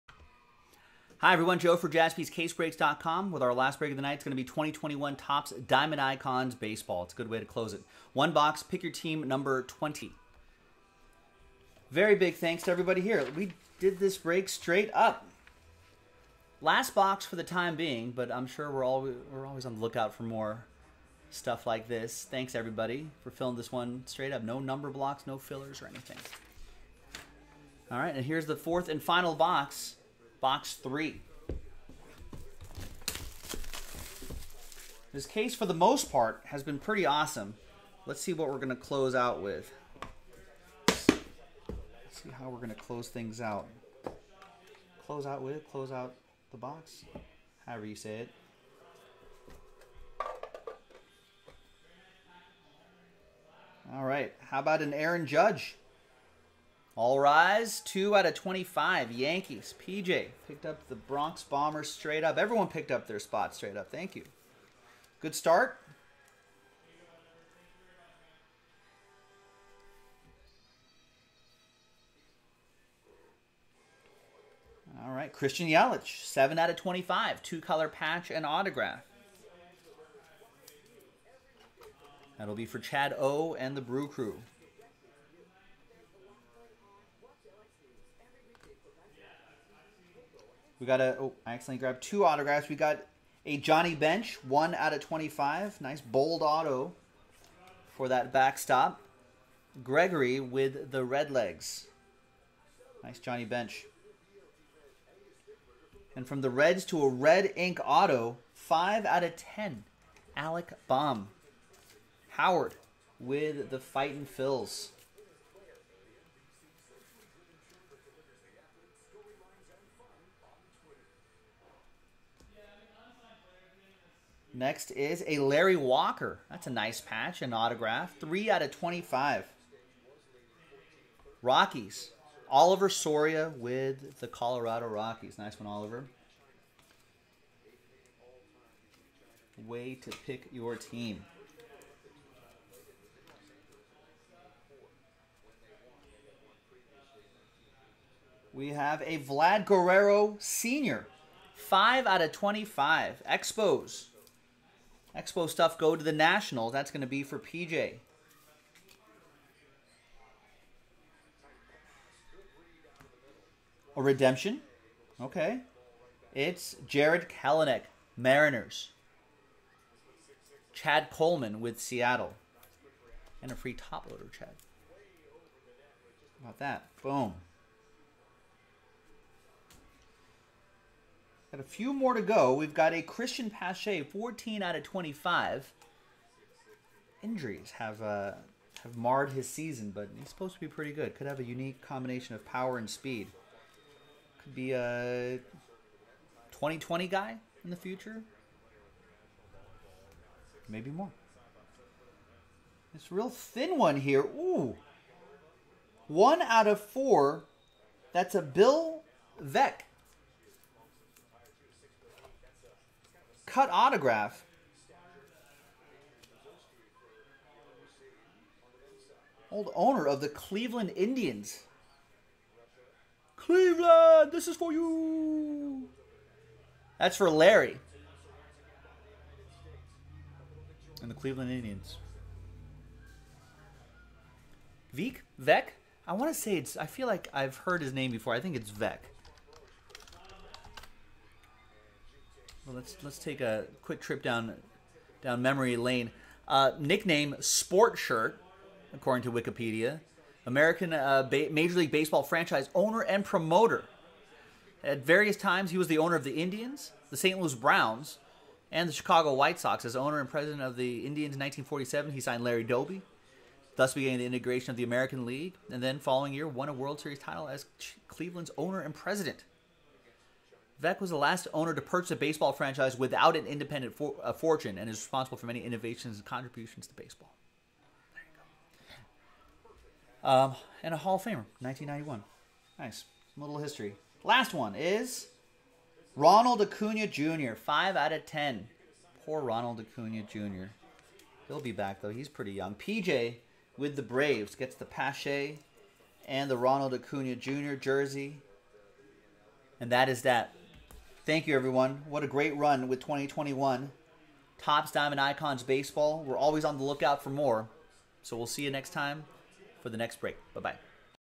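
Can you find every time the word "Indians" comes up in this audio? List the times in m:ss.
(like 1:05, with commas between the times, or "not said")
3:40, 3:51, 4:16, 4:20.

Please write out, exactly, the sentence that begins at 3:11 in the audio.
Could have a unique combination of power and speed.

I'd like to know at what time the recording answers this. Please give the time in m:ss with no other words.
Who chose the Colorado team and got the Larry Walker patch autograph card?
2:12.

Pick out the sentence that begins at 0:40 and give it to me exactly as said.
Let's see how we're going to close things out.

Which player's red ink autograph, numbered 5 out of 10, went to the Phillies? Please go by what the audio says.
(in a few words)
Alec Bohm.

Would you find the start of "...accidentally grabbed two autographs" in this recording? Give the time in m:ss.
1:31.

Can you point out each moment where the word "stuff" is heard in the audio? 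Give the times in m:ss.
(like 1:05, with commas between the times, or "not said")
0:21, 2:35.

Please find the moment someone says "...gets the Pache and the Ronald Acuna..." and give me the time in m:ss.
4:54.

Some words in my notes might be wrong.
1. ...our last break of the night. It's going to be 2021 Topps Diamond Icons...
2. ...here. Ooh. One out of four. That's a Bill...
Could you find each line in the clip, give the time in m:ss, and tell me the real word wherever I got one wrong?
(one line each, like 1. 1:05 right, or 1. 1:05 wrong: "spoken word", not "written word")
1. 0:03 right
2. 3:23 right.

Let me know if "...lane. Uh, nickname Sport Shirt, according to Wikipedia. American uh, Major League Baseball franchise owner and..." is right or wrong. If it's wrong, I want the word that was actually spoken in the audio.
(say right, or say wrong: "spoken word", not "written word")
right.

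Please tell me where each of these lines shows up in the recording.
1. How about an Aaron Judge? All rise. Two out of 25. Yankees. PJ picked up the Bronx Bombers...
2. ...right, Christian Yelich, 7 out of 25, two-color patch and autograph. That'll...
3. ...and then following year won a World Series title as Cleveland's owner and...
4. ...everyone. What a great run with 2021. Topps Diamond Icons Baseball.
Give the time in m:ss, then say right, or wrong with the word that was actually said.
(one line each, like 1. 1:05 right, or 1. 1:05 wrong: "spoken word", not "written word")
1. 0:54 right
2. 1:15 right
3. 4:25 right
4. 5:01 right.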